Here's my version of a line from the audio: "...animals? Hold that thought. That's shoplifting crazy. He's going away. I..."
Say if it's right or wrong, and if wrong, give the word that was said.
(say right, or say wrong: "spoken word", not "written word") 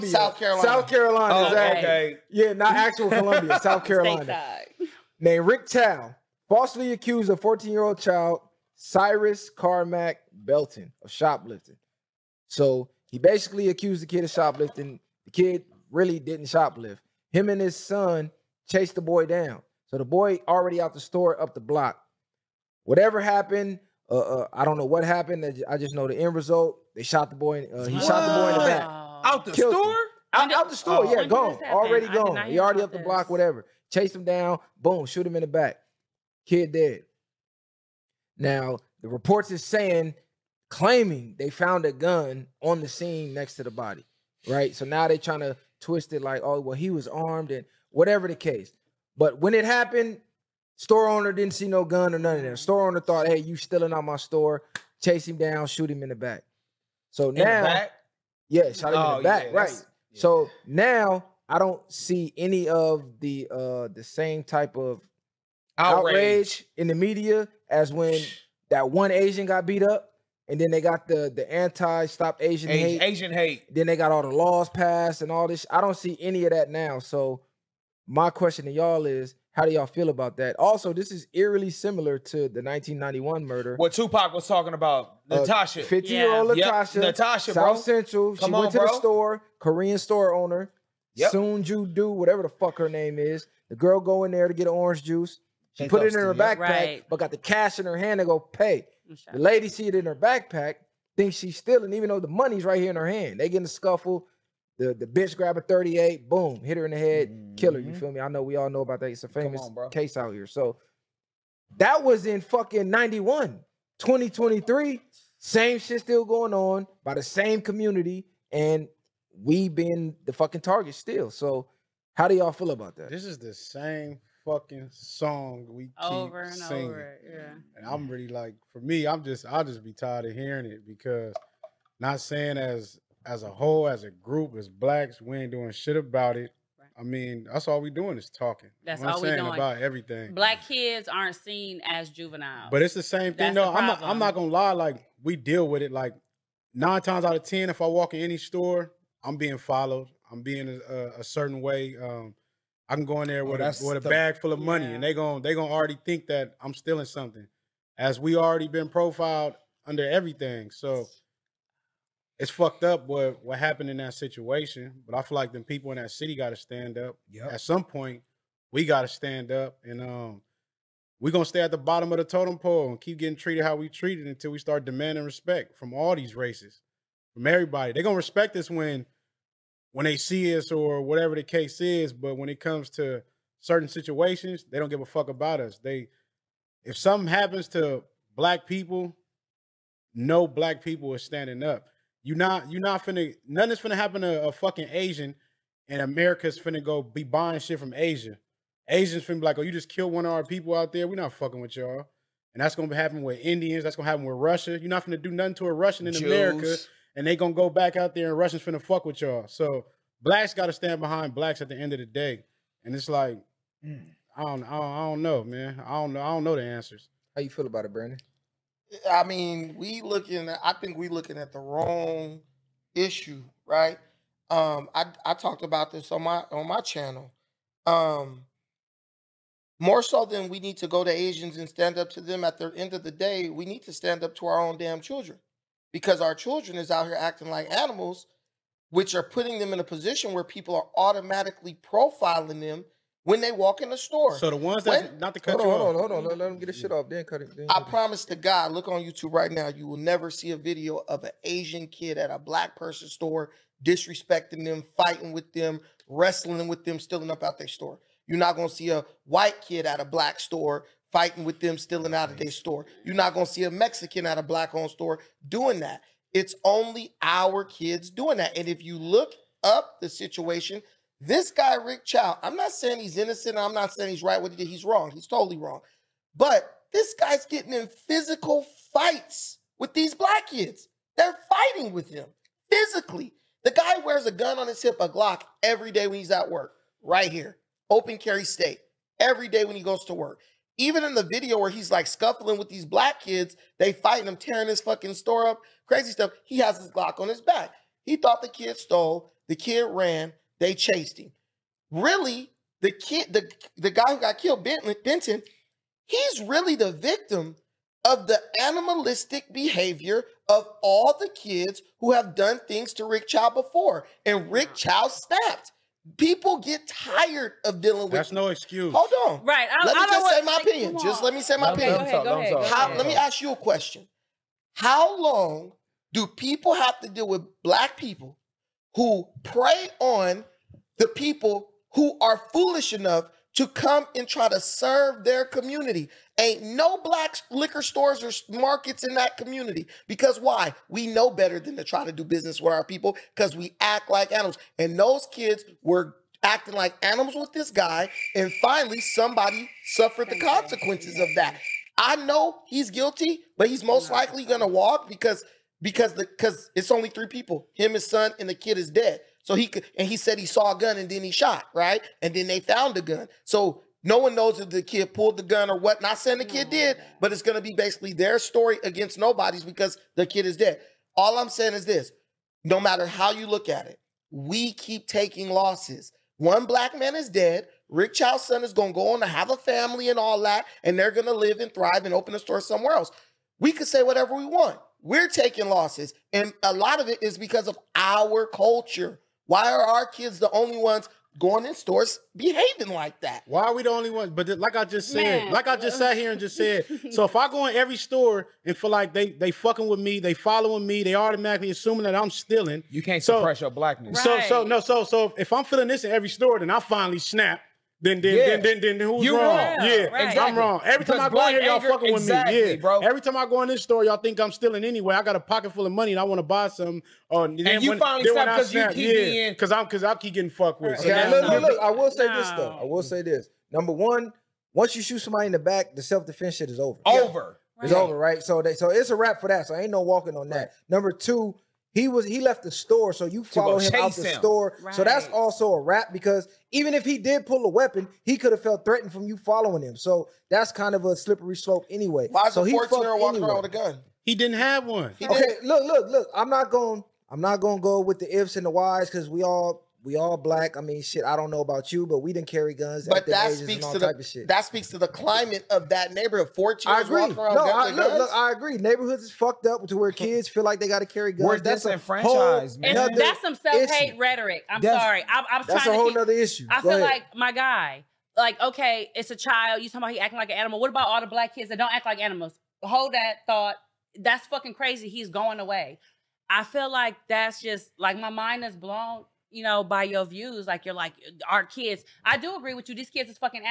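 wrong: "fucking", not "shoplifting".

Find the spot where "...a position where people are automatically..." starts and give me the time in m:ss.
3:59.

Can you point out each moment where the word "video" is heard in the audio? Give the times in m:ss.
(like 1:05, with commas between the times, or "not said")
4:10, 4:51.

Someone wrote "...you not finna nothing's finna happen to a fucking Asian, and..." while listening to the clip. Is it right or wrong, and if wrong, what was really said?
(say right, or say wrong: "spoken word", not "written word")
right.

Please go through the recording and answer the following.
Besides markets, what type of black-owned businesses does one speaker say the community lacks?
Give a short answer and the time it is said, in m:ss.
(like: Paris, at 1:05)
liquor stores, at 5:37.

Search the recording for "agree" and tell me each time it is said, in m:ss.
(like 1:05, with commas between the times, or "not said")
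7:38, 8:02.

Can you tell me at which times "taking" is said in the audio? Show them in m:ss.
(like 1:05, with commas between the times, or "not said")
6:15, 6:25.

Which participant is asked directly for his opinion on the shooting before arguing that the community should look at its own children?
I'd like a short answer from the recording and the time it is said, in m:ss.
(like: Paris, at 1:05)
Brandon, at 3:37.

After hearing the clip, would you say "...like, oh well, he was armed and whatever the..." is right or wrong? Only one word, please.
right.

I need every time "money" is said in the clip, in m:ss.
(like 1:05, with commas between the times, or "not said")
1:42, 2:34, 6:55.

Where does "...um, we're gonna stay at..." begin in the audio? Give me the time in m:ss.
2:50.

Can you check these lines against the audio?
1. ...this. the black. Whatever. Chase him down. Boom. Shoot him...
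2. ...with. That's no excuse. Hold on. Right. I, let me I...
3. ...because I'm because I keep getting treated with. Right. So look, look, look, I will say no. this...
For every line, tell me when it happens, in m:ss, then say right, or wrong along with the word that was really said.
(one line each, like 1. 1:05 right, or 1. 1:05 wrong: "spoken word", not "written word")
1. 0:32 wrong: "block", not "black"
2. 5:18 right
3. 6:59 wrong: "fucked", not "treated".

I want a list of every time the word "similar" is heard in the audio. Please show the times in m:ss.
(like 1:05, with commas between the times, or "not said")
1:21.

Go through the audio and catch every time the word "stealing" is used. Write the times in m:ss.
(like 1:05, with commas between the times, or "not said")
0:53, 1:41, 2:36, 4:16, 4:21, 6:42, 6:54.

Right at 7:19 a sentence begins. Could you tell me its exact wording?
So that's kind of a slippery slope anyway.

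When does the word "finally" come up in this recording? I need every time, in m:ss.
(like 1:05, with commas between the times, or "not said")
5:48, 6:46, 6:57.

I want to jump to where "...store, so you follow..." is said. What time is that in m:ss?
7:12.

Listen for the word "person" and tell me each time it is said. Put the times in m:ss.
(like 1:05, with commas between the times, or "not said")
4:12.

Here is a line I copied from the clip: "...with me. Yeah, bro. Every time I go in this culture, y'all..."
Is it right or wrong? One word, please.
wrong.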